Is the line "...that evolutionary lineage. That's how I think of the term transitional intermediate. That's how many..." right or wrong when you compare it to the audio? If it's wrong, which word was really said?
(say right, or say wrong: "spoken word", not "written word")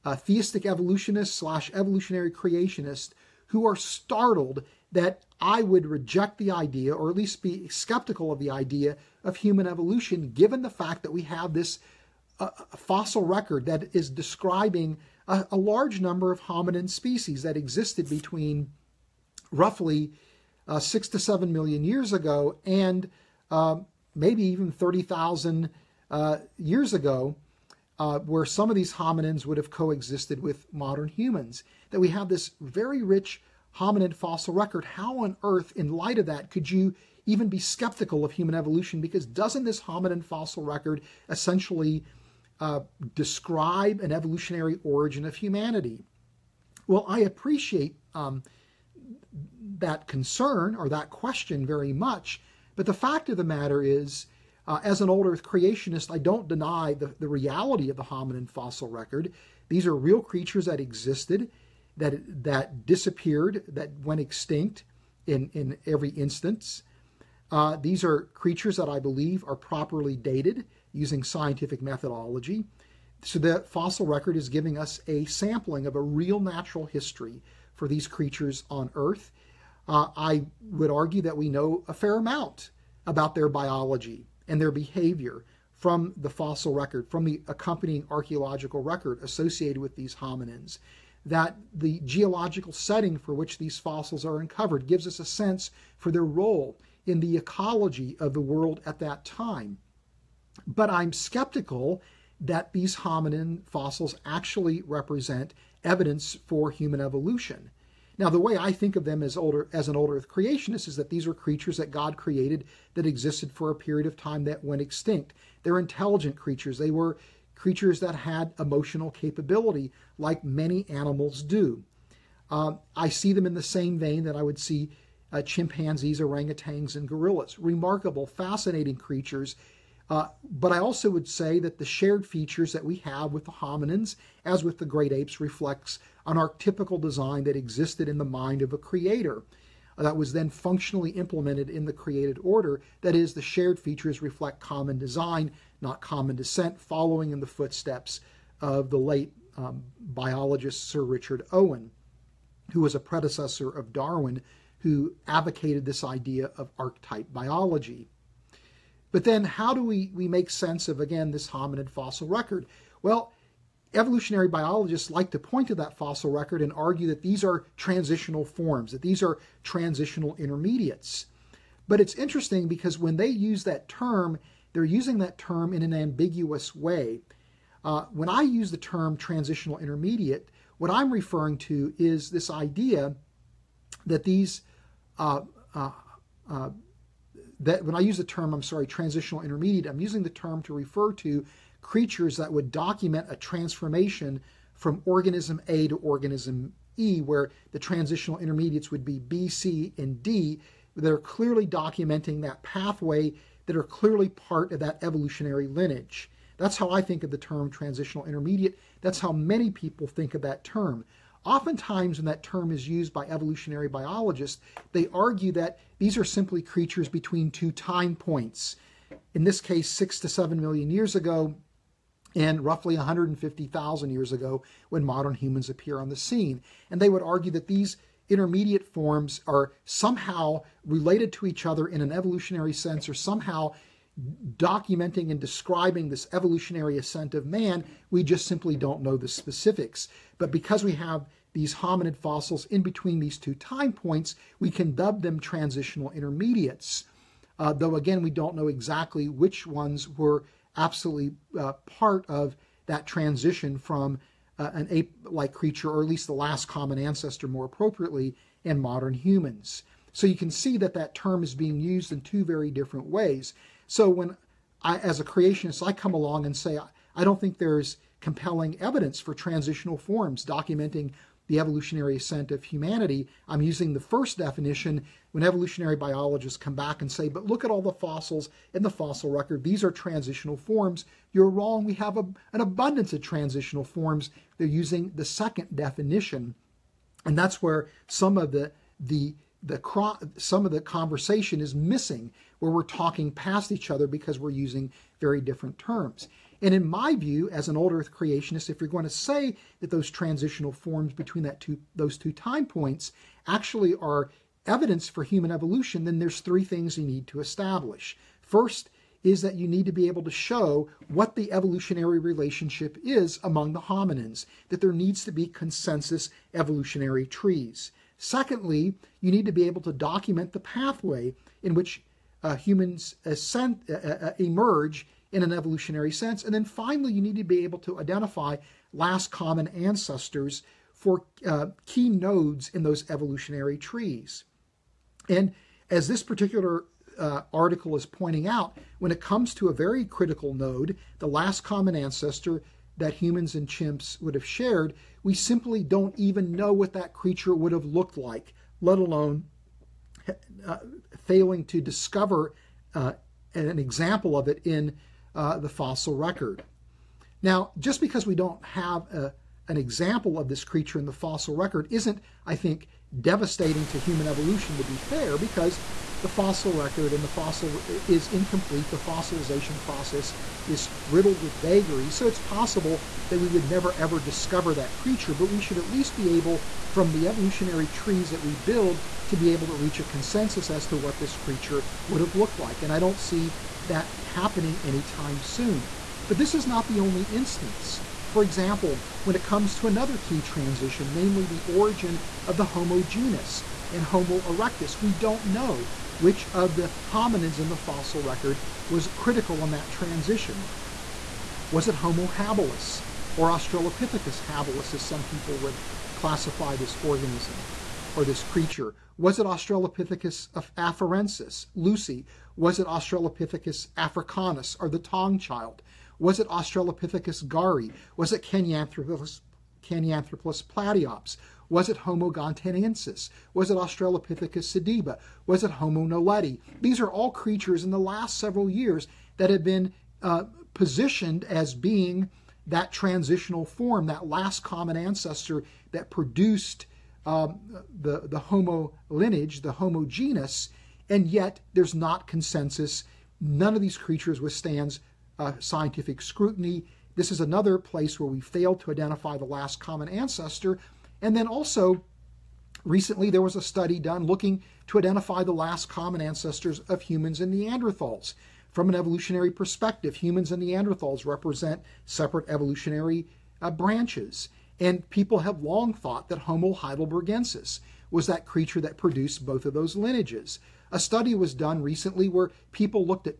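right.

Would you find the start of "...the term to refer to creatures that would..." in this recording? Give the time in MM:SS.
03:10.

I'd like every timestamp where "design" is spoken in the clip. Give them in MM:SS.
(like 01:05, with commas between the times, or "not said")
02:17, 02:24.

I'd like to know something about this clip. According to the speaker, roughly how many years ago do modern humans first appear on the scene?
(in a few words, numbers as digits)
150,000 years ago.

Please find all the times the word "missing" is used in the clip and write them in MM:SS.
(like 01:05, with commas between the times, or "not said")
04:51.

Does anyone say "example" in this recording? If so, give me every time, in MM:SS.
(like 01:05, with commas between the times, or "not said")
05:53, 05:59, 06:28.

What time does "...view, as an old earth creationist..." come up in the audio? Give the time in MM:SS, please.
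04:57.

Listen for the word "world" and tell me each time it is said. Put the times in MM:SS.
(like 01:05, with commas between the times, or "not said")
01:38.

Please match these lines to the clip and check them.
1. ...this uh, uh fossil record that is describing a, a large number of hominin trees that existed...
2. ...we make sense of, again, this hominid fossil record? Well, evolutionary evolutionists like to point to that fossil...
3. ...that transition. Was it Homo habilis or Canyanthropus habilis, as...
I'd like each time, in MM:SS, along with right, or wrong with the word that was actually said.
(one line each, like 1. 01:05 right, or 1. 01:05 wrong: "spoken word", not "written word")
1. 00:11 wrong: "species", not "trees"
2. 02:40 wrong: "biologists", not "evolutionists"
3. 06:39 wrong: "Australopithecus", not "Canyanthropus".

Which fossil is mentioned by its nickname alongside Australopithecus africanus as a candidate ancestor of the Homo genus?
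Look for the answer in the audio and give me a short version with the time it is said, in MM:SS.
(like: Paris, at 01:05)
Taung child, at 06:54.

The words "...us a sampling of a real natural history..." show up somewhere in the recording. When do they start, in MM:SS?
01:14.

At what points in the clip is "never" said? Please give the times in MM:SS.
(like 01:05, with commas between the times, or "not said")
06:13.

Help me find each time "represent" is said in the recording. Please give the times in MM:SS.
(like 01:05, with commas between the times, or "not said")
01:44, 07:41.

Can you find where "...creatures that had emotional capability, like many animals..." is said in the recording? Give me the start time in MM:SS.
01:57.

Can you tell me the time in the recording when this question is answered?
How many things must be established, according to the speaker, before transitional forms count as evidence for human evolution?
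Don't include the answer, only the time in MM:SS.
05:06.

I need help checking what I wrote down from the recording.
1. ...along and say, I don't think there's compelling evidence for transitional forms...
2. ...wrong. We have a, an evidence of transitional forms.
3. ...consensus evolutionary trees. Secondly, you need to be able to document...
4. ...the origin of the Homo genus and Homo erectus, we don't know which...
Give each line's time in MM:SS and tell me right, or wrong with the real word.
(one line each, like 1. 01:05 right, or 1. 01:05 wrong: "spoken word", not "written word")
1. 04:26 right
2. 04:41 wrong: "abundance", not "evidence"
3. 05:15 right
4. 06:31 right.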